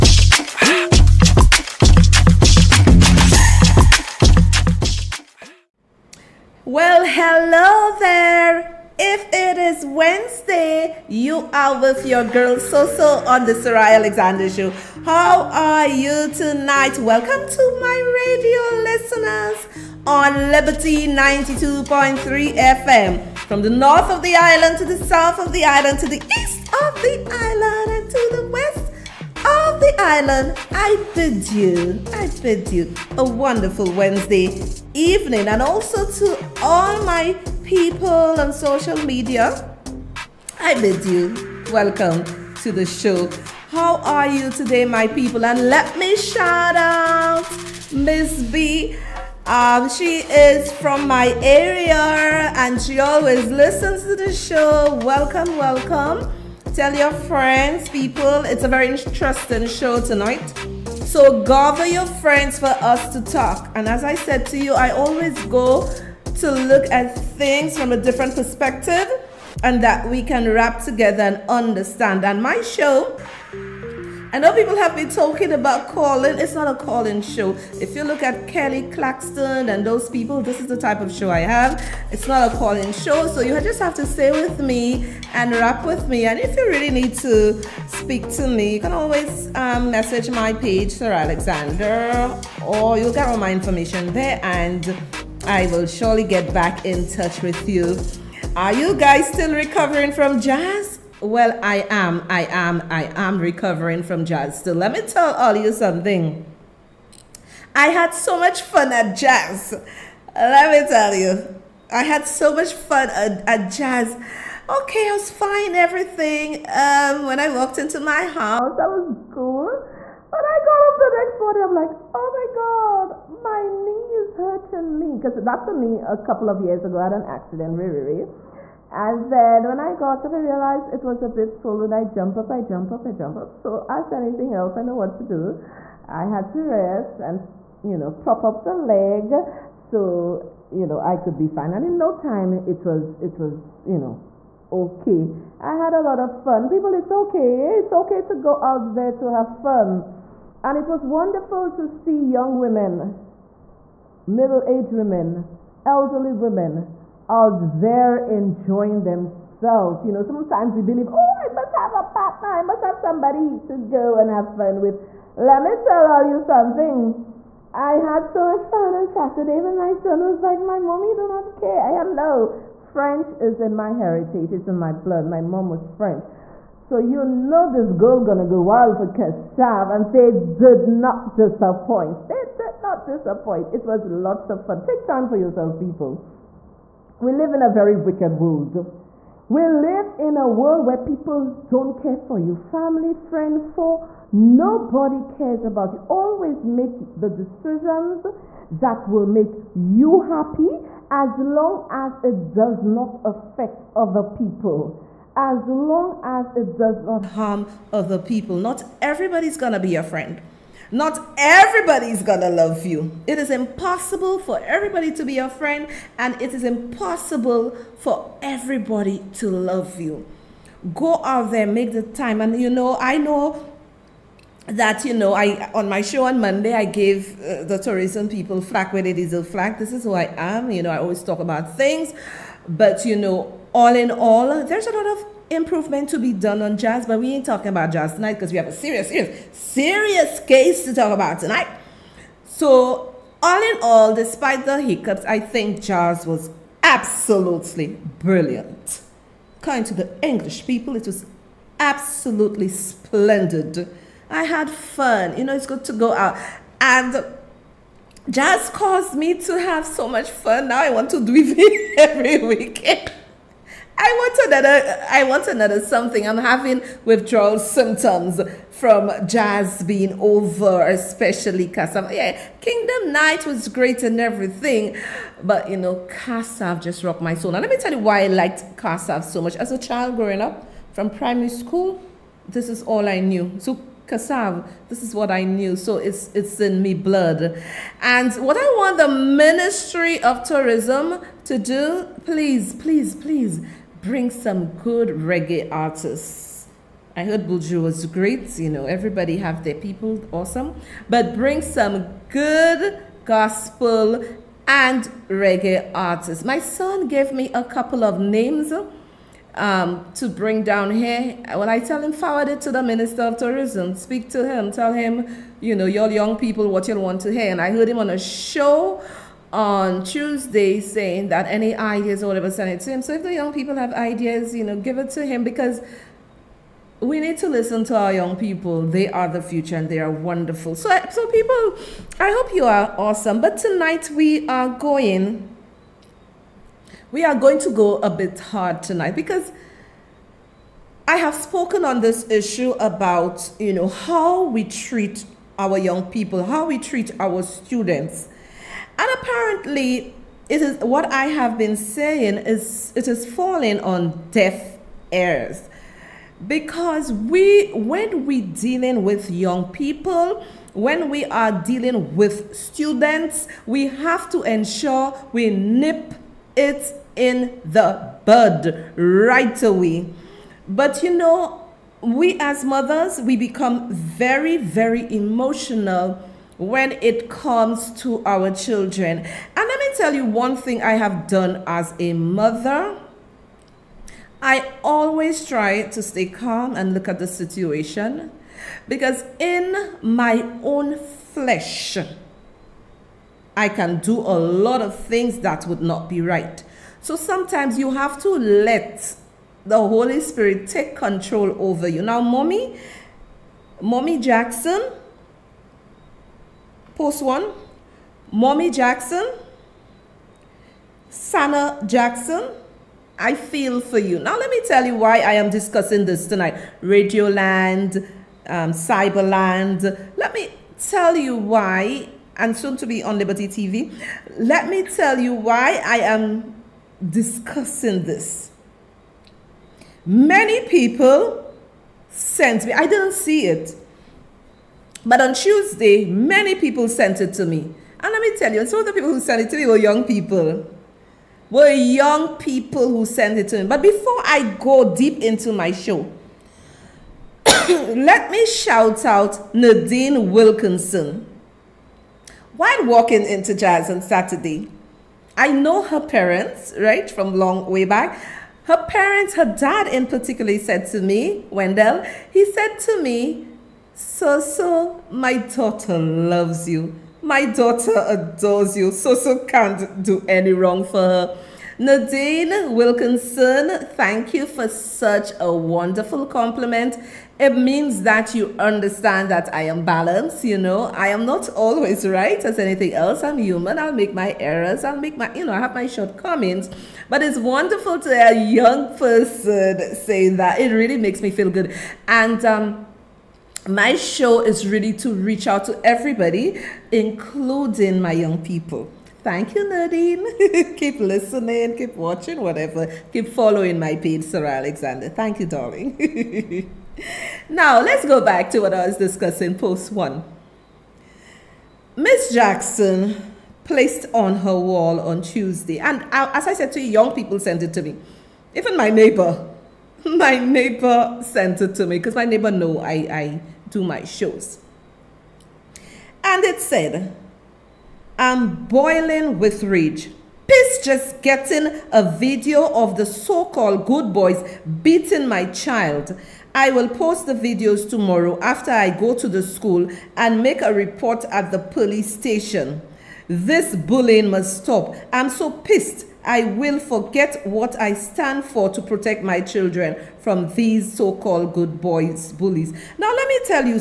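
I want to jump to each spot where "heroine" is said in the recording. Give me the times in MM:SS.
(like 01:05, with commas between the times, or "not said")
not said.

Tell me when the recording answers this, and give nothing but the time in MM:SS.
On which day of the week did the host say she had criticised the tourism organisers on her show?
03:46.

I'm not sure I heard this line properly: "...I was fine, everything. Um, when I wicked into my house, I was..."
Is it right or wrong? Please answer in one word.
wrong.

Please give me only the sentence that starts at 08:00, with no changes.
I am not always right as anything else.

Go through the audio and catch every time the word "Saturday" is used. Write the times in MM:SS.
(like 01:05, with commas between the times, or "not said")
02:49, 07:34.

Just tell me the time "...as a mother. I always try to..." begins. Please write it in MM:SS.
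06:21.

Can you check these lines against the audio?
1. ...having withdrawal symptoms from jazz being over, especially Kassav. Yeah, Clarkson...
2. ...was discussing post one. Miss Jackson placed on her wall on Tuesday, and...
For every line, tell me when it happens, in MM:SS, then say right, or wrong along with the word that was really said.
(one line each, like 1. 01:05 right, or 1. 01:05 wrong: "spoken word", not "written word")
1. 04:26 wrong: "Kingdom", not "Clarkson"
2. 08:28 right.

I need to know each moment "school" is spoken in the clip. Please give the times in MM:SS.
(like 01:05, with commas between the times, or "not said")
04:41, 08:59.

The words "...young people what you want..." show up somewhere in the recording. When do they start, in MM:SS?
05:16.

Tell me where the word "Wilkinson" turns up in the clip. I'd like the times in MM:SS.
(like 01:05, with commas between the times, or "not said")
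07:30, 07:52.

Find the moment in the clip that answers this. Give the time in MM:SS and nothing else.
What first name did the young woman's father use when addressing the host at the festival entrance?
07:41.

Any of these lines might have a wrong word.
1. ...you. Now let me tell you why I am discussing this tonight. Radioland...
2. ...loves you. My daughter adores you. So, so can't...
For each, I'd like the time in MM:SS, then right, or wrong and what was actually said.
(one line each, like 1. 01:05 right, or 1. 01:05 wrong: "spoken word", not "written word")
1. 06:53 right
2. 07:45 right.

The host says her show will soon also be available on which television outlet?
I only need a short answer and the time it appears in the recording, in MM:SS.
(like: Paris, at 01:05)
Liberty TV, at 07:03.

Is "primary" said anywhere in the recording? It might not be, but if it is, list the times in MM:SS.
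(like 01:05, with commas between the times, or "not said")
04:41.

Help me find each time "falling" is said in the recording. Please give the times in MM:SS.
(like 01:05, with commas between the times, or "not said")
05:53.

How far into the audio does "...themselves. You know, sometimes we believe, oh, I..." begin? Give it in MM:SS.
02:39.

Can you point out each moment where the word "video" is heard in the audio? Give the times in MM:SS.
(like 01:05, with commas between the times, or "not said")
08:52, 08:57.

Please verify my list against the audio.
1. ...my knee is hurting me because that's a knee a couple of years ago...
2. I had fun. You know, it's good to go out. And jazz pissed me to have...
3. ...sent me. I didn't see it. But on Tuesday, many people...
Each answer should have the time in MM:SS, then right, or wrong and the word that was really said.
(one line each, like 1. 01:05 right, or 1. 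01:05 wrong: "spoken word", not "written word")
1. 02:03 right
2. 04:14 wrong: "caused", not "pissed"
3. 07:12 right.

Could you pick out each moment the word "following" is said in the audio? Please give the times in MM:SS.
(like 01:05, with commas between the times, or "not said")
08:23.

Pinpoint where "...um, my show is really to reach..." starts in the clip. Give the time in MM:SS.
08:12.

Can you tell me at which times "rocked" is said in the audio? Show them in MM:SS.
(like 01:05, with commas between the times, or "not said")
04:37.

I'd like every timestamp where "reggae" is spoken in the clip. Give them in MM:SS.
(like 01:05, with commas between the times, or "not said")
04:55, 05:05.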